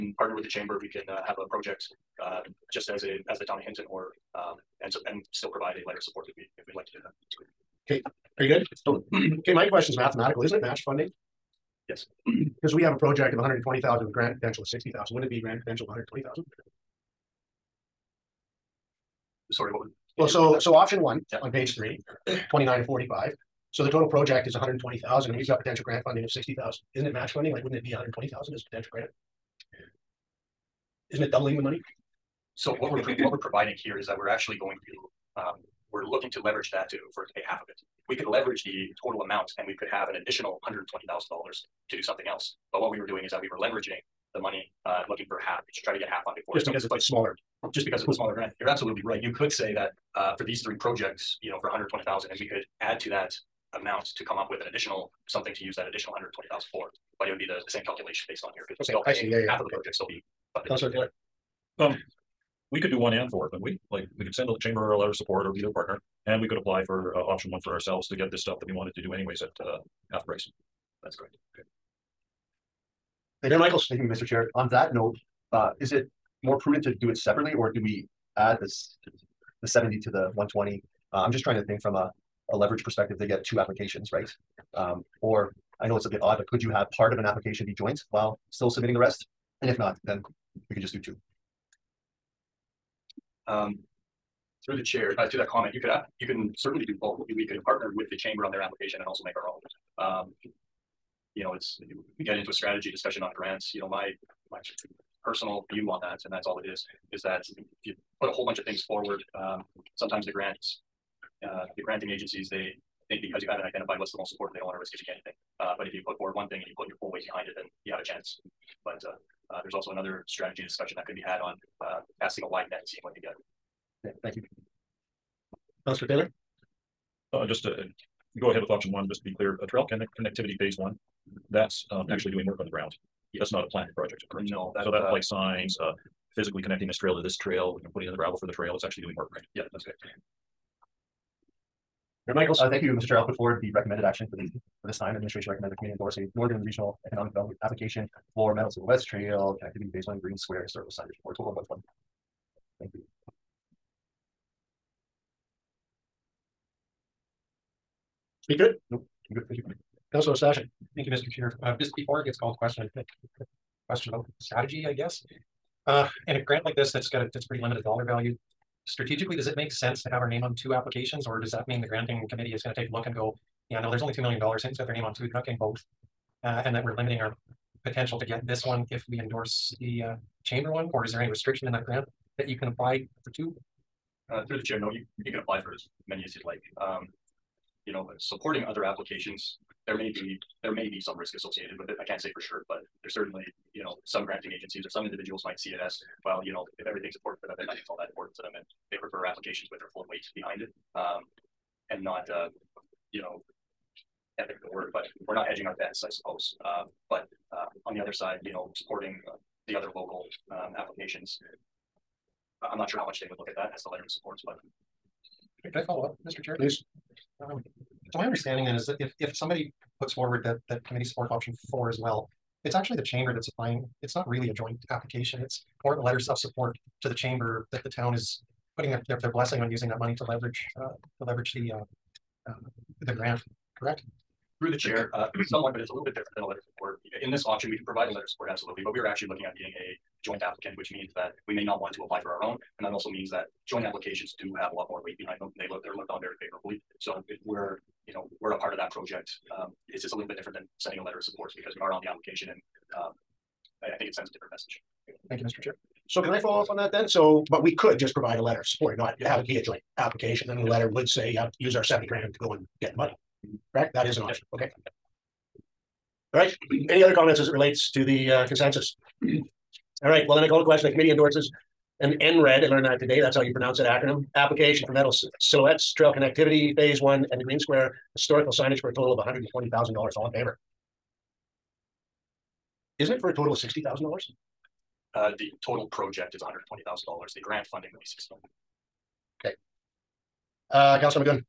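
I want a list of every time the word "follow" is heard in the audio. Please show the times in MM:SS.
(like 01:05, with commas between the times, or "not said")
03:35, 04:16.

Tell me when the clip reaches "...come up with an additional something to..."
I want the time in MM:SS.
00:54.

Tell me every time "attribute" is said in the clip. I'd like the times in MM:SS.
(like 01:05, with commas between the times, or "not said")
not said.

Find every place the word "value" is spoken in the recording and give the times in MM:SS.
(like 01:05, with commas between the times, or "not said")
02:48.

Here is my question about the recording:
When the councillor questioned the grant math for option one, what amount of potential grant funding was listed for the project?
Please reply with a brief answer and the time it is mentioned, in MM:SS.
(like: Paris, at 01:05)
$60,000, at 00:26.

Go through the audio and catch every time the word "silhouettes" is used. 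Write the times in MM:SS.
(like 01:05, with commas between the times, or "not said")
02:28, 04:35.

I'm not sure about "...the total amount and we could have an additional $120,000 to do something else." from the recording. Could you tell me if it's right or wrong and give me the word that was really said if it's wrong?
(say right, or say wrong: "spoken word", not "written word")
right.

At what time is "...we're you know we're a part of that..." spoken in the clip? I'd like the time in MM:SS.
04:07.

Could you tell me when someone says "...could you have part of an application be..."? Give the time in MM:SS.
01:26.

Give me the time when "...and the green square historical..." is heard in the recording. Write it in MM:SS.
04:37.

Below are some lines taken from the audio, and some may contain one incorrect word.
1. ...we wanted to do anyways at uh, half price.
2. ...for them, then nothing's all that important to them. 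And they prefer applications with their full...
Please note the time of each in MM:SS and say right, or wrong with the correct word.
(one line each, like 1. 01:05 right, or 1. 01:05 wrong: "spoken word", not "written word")
1. 01:08 right
2. 03:17 right.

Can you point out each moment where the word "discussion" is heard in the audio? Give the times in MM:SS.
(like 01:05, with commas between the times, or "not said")
01:42, 02:00.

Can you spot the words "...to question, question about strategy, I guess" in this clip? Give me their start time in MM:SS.
02:42.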